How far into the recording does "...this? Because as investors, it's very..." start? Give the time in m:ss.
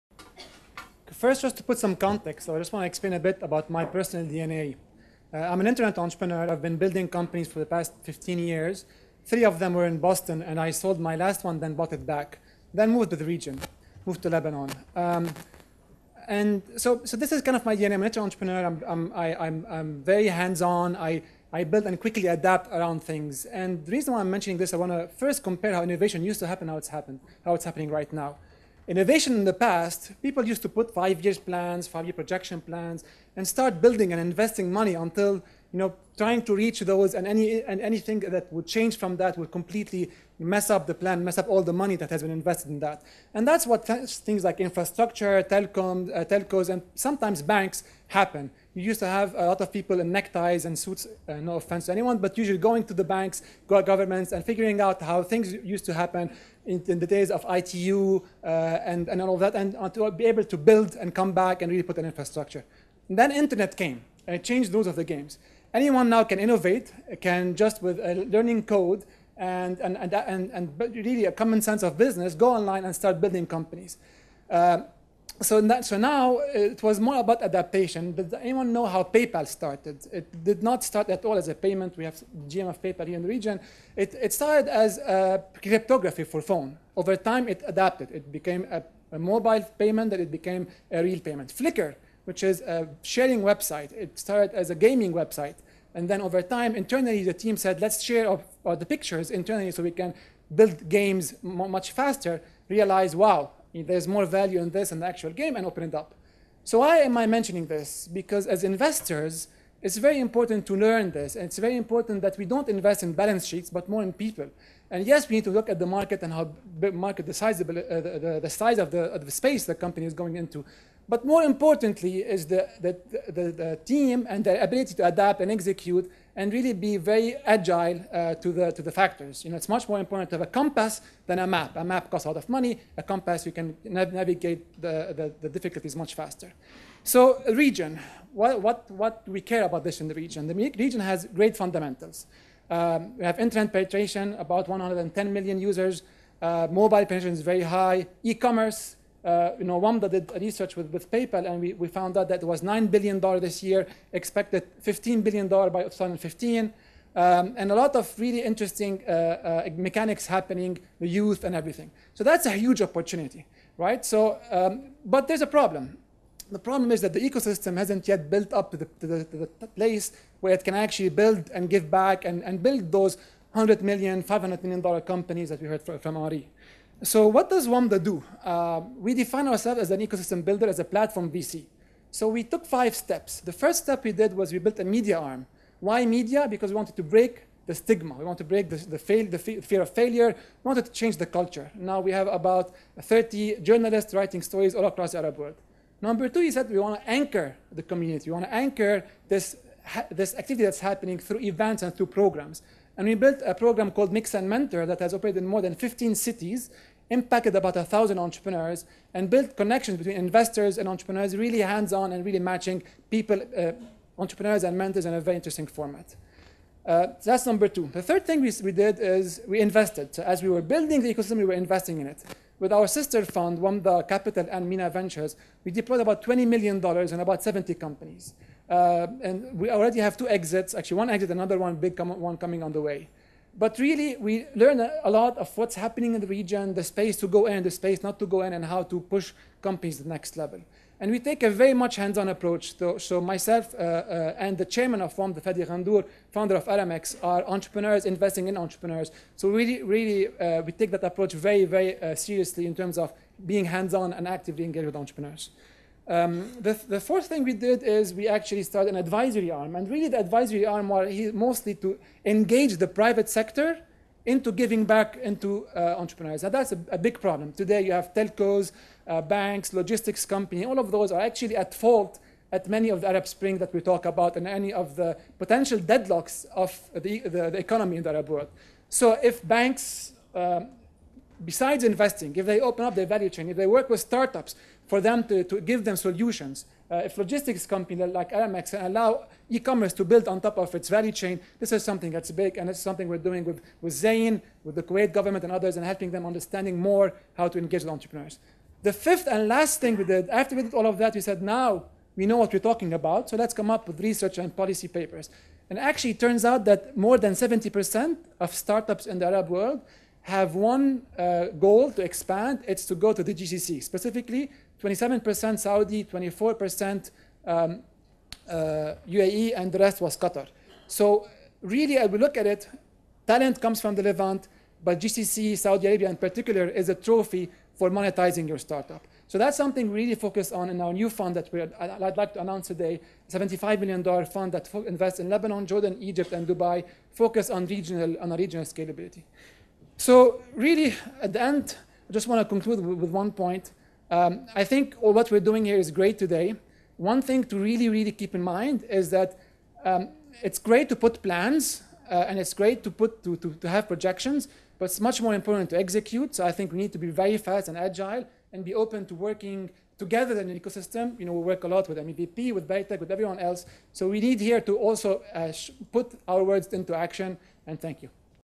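1:47.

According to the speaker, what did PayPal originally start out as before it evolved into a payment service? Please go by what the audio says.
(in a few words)
Cryptography for phone.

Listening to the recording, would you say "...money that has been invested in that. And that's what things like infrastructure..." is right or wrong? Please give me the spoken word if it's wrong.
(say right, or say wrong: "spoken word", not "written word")
right.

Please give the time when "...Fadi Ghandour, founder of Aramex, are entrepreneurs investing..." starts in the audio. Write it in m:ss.
4:05.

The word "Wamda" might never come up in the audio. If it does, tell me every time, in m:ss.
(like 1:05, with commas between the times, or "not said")
2:29, 2:57, 3:43.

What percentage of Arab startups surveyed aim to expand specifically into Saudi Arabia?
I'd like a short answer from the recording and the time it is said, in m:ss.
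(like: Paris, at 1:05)
27%, at 5:14.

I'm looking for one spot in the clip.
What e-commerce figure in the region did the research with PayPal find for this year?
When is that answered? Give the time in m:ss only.
2:32.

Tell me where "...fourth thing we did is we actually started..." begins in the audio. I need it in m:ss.
4:16.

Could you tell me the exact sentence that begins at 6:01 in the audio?
You know, we work a lot with MEVP, with Berytech, with everyone else.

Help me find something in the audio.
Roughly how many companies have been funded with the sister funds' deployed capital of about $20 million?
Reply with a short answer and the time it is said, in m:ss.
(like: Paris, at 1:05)
70, at 3:47.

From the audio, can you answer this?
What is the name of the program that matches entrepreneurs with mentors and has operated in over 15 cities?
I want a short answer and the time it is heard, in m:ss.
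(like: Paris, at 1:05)
Mix and Mentor, at 3:24.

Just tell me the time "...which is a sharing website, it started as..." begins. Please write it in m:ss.
1:32.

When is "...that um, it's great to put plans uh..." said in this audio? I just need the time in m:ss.
5:49.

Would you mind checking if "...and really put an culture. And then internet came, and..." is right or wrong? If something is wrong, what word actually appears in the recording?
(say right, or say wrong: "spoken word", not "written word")
wrong: "infrastructure", not "culture".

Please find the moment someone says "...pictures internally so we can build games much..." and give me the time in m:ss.
1:38.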